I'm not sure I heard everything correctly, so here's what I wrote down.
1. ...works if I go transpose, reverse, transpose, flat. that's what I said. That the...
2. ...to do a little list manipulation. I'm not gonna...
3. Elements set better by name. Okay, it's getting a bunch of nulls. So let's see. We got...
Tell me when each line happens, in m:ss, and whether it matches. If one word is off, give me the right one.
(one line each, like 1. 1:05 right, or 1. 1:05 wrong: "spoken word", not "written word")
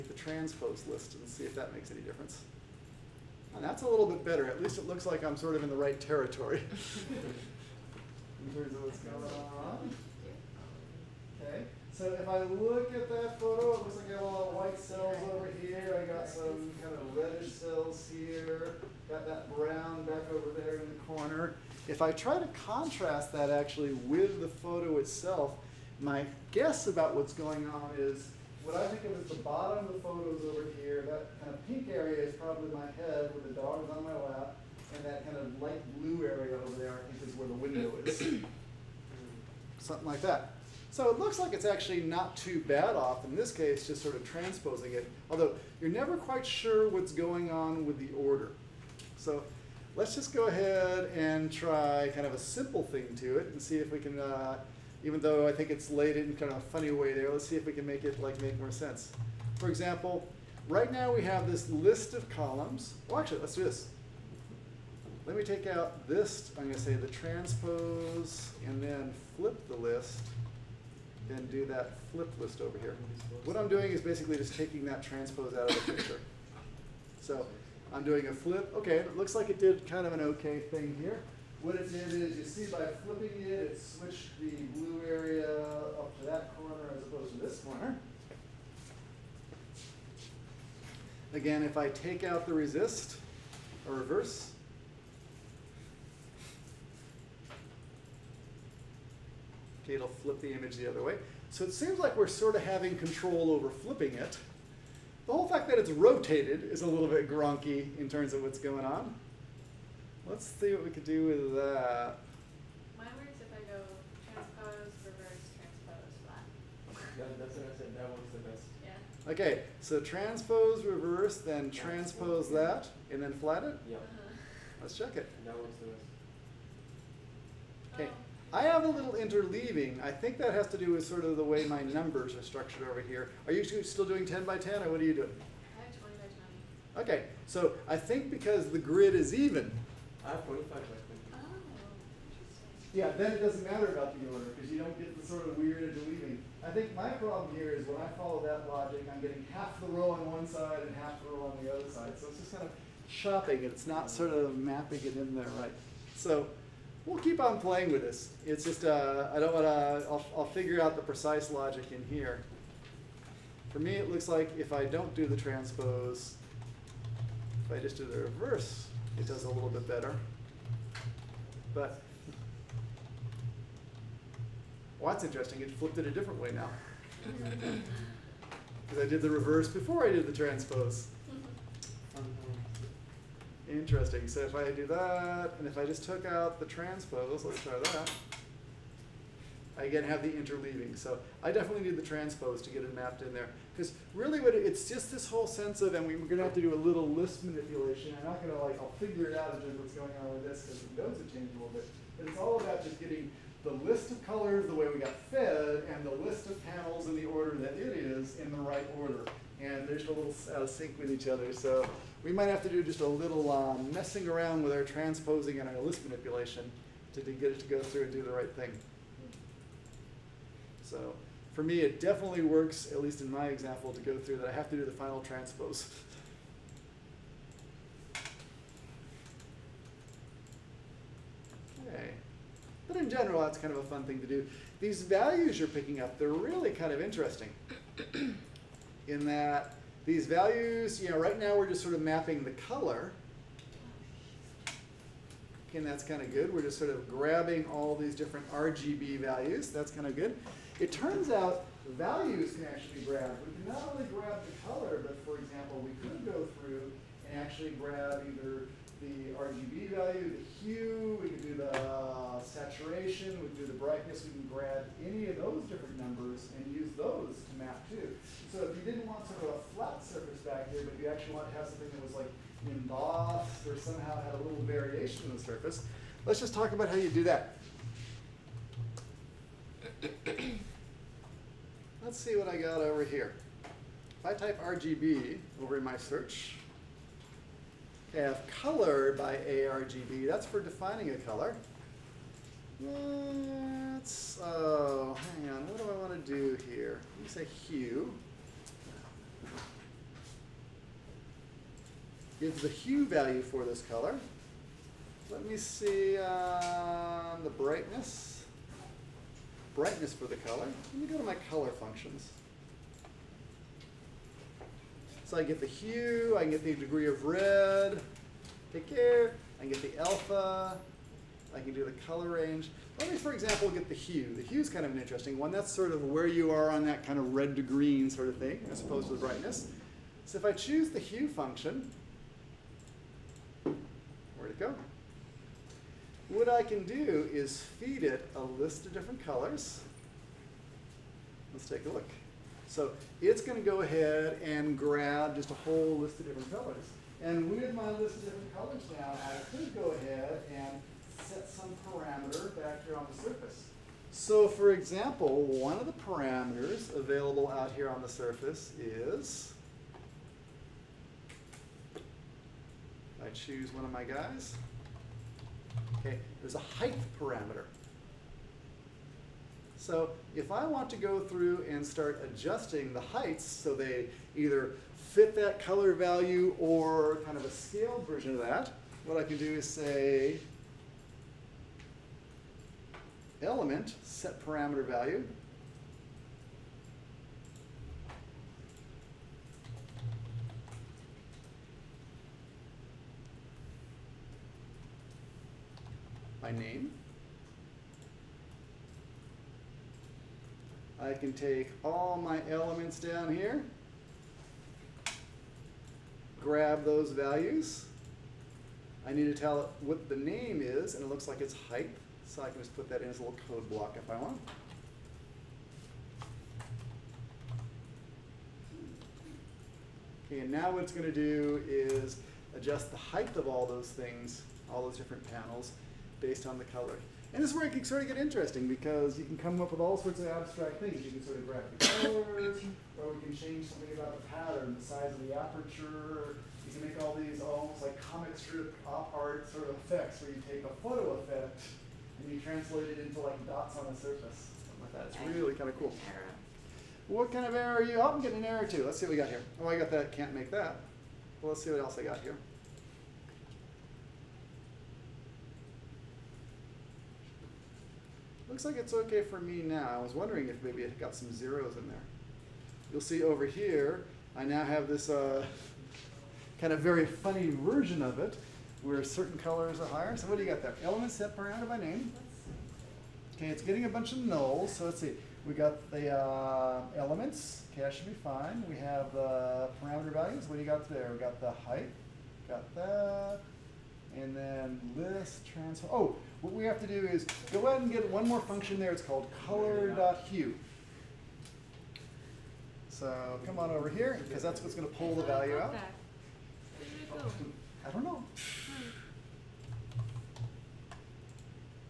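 1. 1:53 right
2. 3:16 right
3. 7:50 wrong: "parameter", not "better".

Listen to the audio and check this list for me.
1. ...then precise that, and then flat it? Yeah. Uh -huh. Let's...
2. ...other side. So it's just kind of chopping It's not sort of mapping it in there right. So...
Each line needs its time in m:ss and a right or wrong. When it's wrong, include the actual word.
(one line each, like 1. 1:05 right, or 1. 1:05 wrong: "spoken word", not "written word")
1. 2:01 wrong: "transpose", not "precise"
2. 2:31 right.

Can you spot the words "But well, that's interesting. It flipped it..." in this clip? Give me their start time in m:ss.
2:51.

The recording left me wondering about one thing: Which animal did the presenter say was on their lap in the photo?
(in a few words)
dog.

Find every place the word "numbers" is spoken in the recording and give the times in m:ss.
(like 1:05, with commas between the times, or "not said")
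2:11, 4:25.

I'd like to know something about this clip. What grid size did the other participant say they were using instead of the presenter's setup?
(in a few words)
20 by 20.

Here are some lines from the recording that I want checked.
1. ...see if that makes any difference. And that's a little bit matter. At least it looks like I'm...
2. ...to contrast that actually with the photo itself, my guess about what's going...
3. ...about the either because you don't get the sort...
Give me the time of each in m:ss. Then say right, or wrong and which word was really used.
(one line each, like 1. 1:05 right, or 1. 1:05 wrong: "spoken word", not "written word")
1. 0:01 wrong: "better", not "matter"
2. 0:22 right
3. 2:23 wrong: "order", not "either".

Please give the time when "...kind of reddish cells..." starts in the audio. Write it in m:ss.
0:16.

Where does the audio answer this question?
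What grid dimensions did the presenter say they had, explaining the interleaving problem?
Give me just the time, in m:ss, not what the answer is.
2:20.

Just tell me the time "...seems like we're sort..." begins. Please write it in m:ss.
1:41.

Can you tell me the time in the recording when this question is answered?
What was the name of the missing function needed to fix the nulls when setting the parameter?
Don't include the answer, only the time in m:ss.
8:09.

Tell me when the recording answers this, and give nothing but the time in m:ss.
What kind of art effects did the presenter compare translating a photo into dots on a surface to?
7:17.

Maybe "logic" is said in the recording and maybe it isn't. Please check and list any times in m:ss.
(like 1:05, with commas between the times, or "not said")
2:28, 2:41.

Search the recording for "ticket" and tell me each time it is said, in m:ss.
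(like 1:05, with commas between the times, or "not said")
not said.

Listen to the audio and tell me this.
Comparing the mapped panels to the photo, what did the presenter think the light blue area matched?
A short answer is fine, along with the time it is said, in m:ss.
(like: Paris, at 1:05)
the window, at 0:37.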